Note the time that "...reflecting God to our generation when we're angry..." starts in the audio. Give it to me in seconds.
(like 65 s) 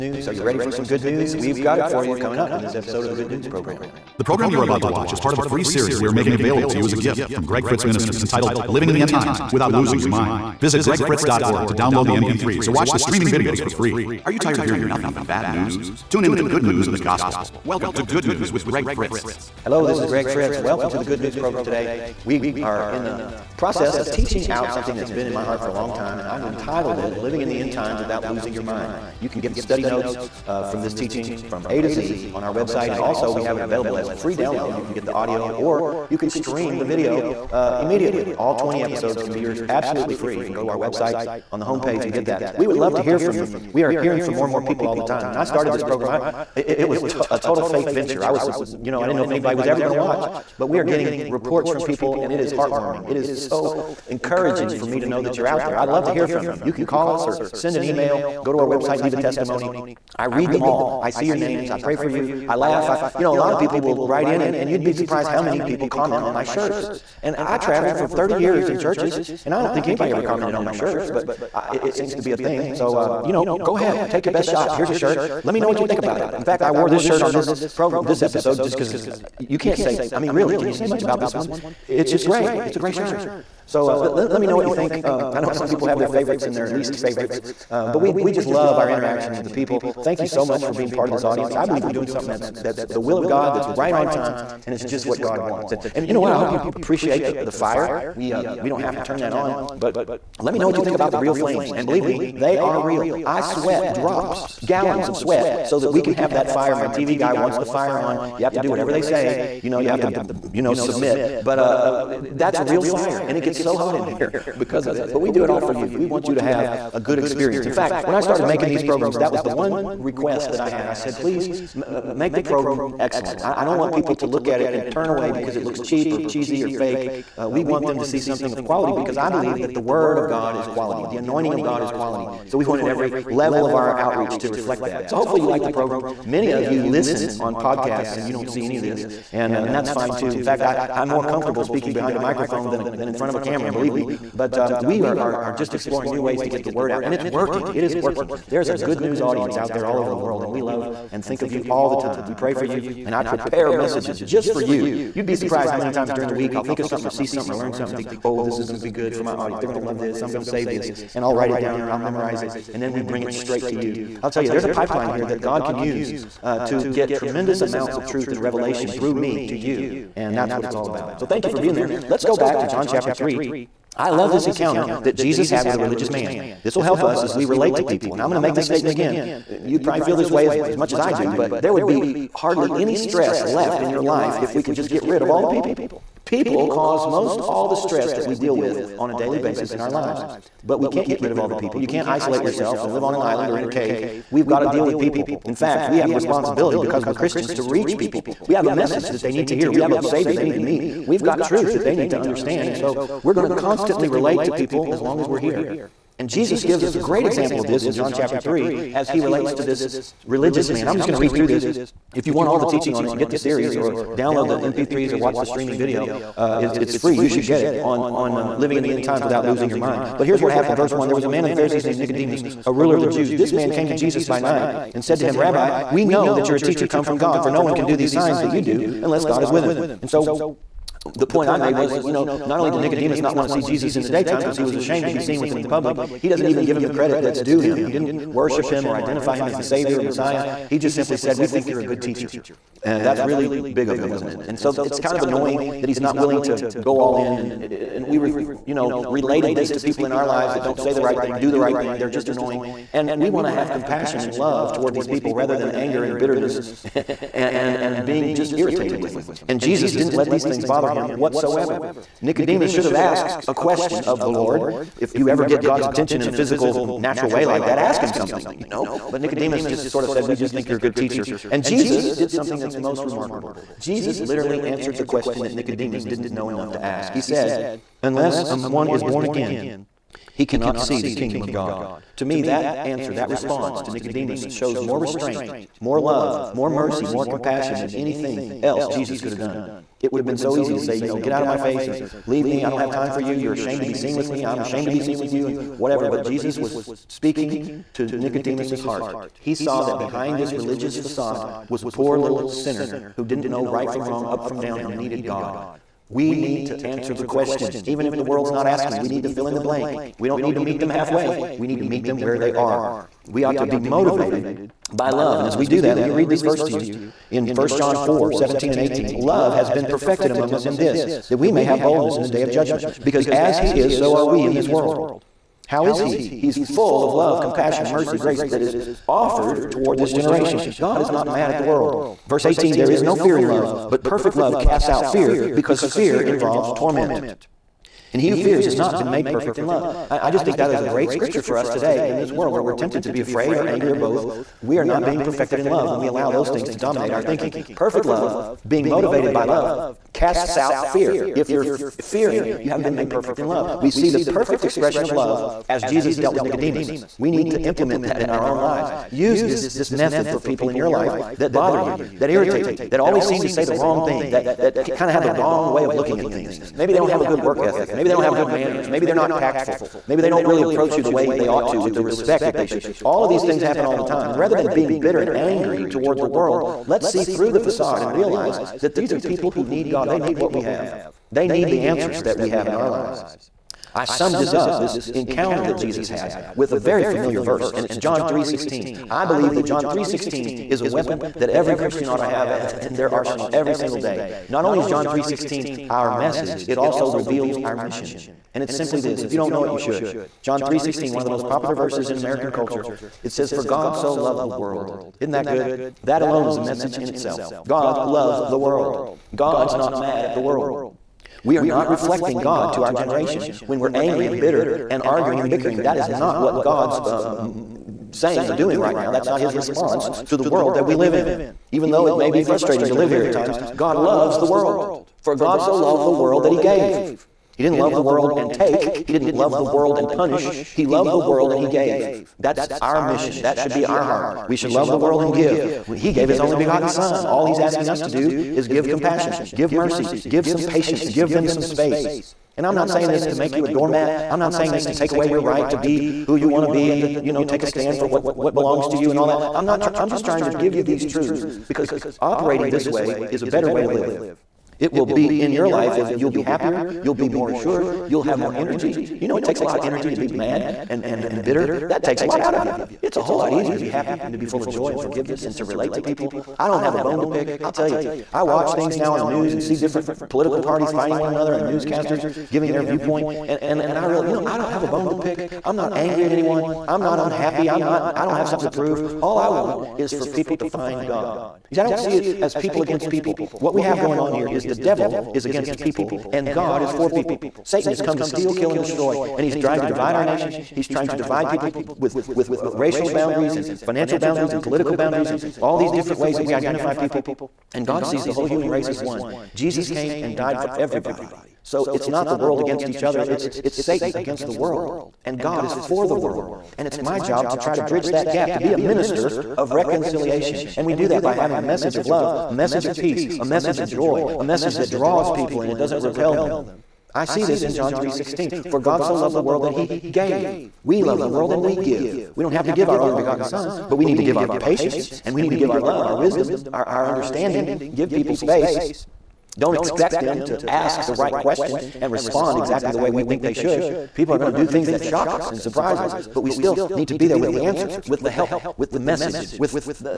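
411 s.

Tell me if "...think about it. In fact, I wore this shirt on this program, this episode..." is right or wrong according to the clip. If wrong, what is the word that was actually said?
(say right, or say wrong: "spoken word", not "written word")
right.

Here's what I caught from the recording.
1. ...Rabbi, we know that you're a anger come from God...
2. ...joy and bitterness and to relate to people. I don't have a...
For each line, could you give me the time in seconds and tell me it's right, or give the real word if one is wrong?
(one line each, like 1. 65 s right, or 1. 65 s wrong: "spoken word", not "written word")
1. 225 s wrong: "teacher", not "anger"
2. 464 s wrong: "forgiveness", not "bitterness".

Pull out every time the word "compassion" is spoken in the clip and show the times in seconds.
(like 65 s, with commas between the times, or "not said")
253 s, 287 s, 327 s, 438 s.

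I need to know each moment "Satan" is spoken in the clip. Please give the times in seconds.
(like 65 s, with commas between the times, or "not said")
487 s, 503 s.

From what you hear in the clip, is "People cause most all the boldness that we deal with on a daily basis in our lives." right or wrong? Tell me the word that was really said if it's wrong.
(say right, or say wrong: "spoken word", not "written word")
wrong: "stress", not "boldness".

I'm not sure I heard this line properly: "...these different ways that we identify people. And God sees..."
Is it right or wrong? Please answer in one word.
right.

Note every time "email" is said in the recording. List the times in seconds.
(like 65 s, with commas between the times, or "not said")
57 s.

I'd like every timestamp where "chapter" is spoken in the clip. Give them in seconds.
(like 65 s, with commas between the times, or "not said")
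172 s, 208 s.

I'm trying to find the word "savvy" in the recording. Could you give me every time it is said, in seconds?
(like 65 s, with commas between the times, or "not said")
not said.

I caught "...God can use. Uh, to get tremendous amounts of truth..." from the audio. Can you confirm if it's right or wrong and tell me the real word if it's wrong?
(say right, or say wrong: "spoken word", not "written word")
right.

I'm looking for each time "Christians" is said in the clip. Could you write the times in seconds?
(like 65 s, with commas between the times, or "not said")
197 s, 391 s.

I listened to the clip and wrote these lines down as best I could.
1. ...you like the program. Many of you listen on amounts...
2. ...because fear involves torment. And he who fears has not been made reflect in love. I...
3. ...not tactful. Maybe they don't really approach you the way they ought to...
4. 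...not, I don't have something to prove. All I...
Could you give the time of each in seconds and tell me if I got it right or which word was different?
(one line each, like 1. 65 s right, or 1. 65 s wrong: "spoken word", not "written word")
1. 135 s wrong: "podcasts", not "amounts"
2. 335 s wrong: "perfect", not "reflect"
3. 369 s right
4. 477 s right.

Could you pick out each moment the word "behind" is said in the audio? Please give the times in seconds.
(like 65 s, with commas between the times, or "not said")
141 s, 299 s.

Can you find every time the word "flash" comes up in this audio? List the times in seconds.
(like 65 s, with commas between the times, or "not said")
not said.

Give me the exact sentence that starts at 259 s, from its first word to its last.
And Jesus didn't let these things bother him whatsoever.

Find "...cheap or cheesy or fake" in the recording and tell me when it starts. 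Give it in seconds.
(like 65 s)
125 s.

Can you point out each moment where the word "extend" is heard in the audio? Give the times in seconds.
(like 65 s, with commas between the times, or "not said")
not said.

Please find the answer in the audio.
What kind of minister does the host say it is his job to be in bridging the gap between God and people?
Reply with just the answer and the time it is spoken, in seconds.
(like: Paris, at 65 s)
Minister of reconciliation, at 508 s.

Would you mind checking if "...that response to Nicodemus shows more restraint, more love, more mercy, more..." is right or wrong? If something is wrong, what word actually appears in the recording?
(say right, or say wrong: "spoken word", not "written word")
right.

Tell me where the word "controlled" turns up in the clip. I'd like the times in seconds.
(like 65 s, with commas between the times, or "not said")
not said.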